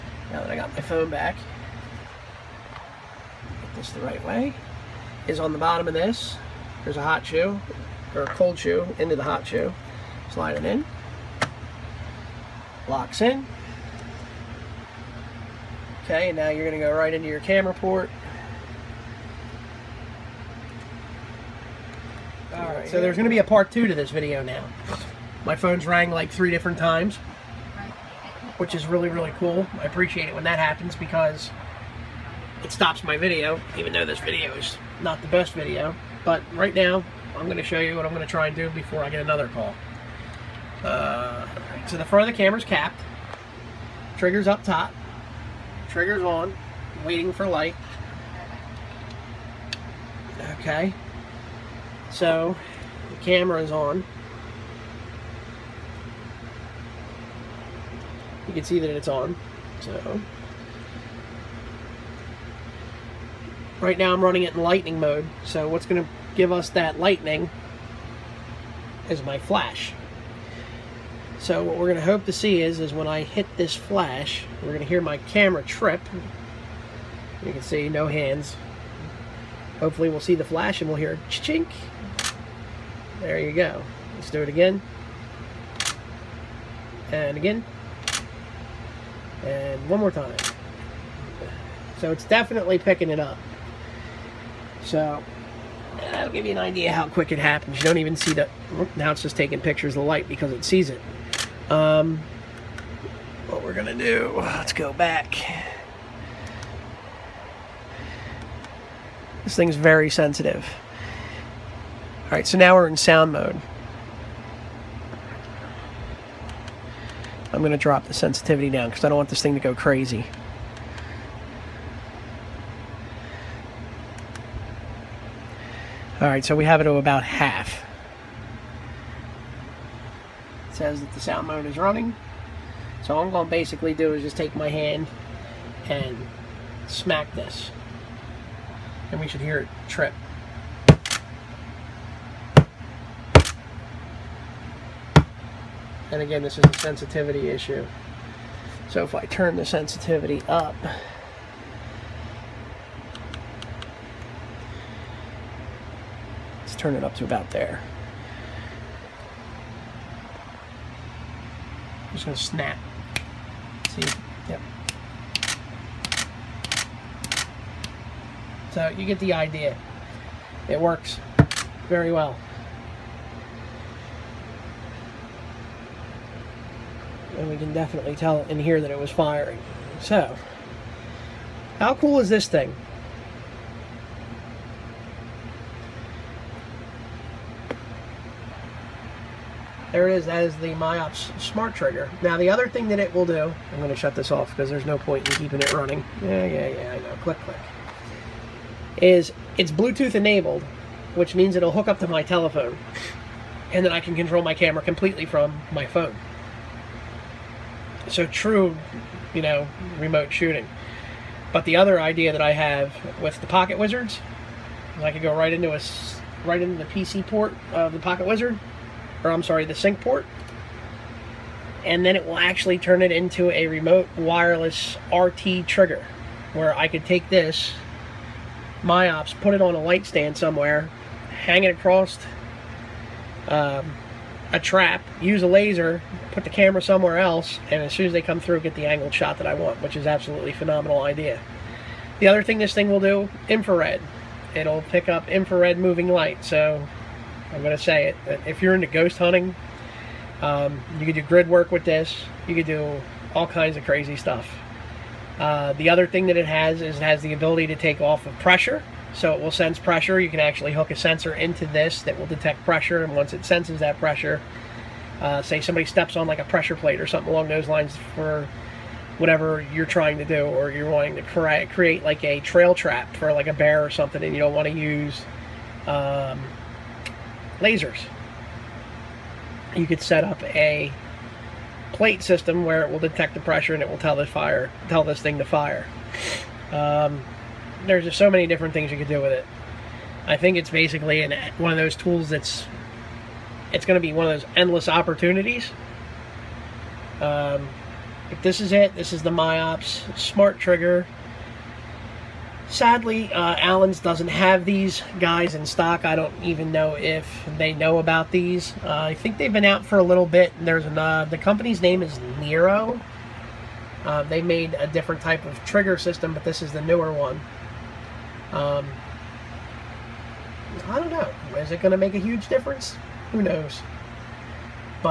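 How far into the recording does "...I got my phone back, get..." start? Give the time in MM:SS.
00:00.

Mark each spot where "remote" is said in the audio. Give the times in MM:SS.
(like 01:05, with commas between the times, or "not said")
03:29, 03:43.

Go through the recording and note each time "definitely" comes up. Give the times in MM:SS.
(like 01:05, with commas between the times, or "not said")
01:32, 02:57.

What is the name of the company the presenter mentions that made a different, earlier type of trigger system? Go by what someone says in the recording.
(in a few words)
Nero.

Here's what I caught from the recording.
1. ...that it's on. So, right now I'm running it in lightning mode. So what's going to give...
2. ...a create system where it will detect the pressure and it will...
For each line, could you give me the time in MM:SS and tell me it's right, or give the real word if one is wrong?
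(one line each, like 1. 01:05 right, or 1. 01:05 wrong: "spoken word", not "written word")
1. 00:58 right
2. 04:40 wrong: "plate", not "create".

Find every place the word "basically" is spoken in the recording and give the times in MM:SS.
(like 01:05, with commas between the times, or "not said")
02:13, 04:50.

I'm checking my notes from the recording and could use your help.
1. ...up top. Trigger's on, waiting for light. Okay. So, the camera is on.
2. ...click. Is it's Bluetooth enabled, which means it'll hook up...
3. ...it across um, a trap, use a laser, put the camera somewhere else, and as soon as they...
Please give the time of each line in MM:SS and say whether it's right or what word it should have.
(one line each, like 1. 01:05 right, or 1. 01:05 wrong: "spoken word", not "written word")
1. 00:44 right
2. 03:17 right
3. 03:51 right.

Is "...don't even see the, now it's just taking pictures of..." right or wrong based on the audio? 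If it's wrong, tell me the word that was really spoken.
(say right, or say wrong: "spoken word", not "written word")
right.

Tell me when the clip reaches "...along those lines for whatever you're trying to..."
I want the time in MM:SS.
04:27.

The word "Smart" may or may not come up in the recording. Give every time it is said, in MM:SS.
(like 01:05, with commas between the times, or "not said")
03:11, 05:00.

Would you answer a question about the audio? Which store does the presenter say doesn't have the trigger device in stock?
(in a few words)
Allen's.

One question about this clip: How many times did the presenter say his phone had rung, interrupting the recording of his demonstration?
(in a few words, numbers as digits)
3.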